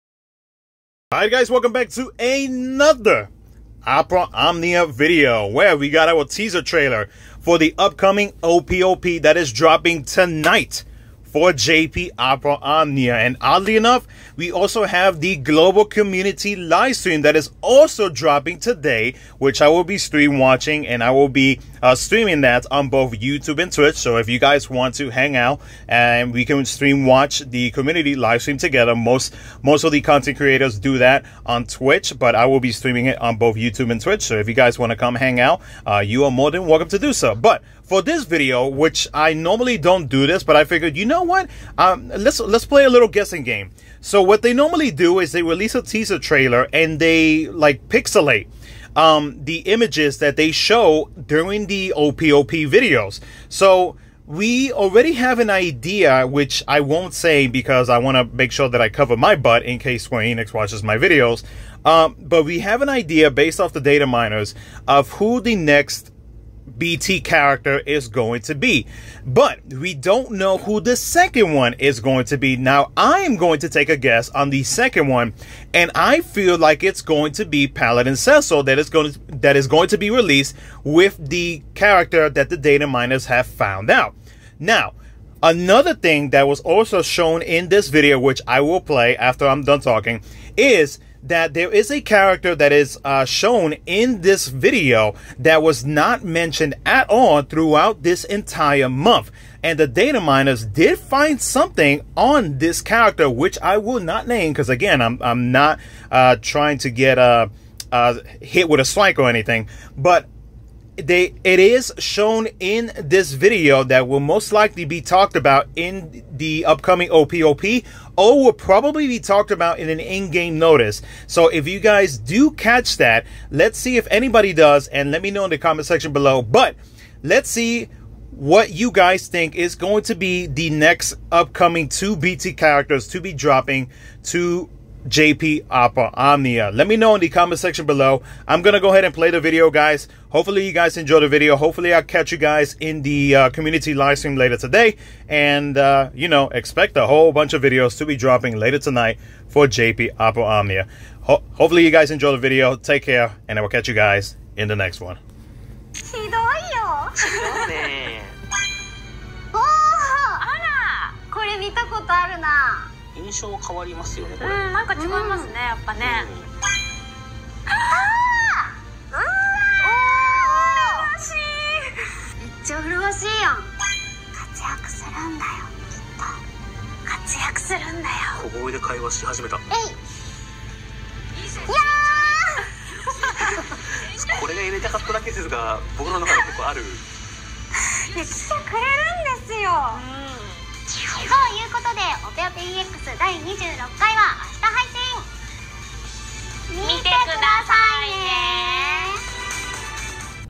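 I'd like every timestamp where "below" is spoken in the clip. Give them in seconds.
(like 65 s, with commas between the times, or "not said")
126 s, 137 s.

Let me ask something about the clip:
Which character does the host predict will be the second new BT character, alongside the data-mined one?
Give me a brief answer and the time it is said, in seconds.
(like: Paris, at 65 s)
Paladin Cecil, at 77 s.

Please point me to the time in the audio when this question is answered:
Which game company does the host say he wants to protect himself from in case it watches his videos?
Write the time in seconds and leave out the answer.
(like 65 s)
60 s.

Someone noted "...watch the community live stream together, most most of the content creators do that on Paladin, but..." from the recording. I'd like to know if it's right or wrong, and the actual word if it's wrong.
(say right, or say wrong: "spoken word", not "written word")
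wrong: "Twitch", not "Paladin".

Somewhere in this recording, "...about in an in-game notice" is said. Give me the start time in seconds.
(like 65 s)
119 s.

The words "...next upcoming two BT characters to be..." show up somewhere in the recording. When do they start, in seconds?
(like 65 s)
130 s.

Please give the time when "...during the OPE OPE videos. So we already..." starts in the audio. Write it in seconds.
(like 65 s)
51 s.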